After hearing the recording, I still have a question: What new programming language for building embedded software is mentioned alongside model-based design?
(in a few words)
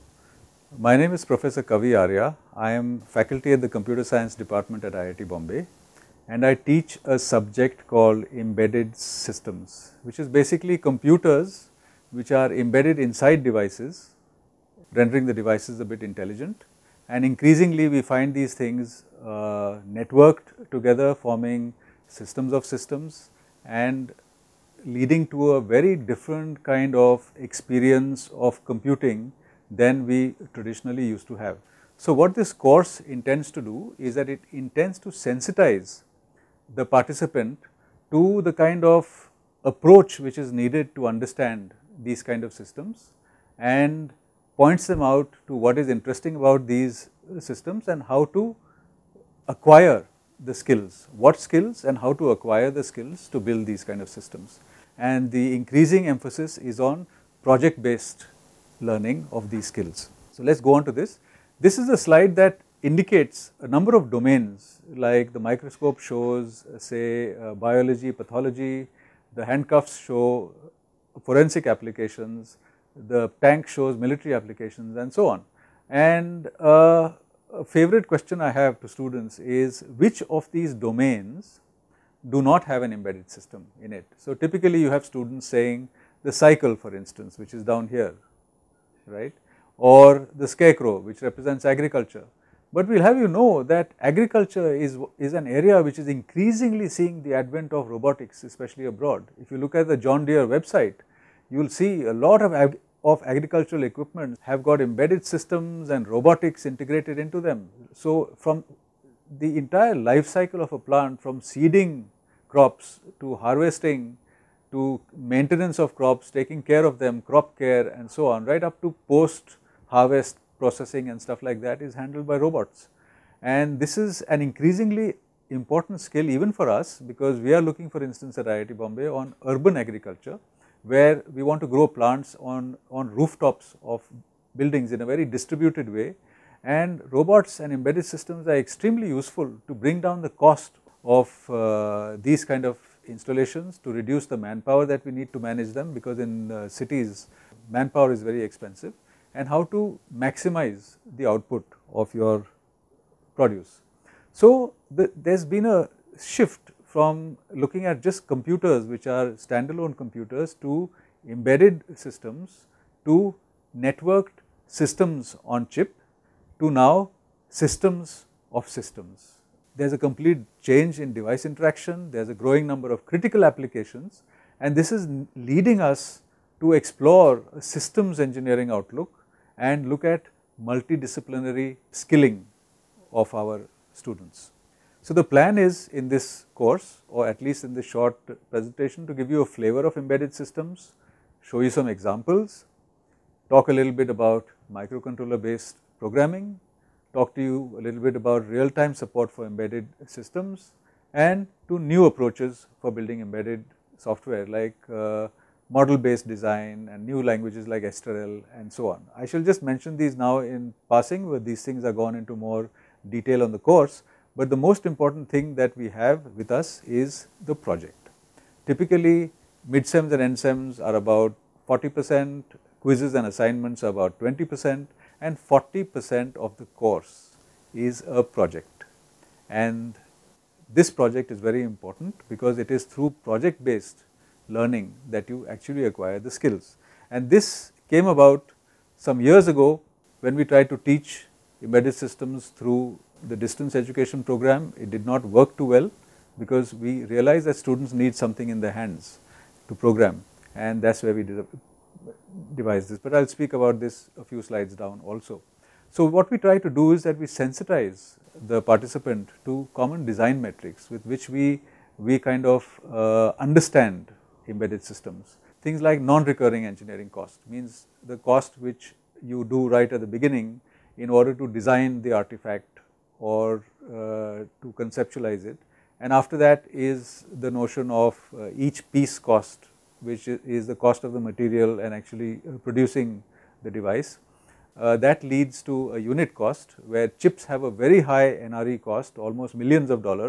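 Esterel.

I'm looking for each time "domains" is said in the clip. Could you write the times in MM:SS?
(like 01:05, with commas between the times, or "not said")
01:04, 01:20.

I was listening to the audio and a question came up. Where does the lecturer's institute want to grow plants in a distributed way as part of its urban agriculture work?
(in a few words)
Rooftops of buildings.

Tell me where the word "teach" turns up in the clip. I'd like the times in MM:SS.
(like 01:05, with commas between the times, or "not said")
00:06, 04:00.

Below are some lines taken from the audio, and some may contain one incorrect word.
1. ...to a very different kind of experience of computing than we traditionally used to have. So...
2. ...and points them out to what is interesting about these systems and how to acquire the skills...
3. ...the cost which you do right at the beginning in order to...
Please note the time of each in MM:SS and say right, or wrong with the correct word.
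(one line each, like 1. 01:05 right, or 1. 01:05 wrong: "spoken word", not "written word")
1. 00:25 right
2. 00:43 right
3. 04:28 right.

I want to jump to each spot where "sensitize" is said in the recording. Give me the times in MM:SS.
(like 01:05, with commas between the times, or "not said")
00:35, 04:17.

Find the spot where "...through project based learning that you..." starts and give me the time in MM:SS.
03:52.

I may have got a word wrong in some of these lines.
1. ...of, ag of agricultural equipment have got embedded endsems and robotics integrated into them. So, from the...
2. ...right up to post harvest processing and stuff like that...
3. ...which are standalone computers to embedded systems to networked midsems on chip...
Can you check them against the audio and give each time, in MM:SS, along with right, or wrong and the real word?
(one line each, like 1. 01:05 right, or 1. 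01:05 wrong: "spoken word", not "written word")
1. 01:42 wrong: "systems", not "endsems"
2. 01:58 right
3. 02:38 wrong: "systems", not "midsems".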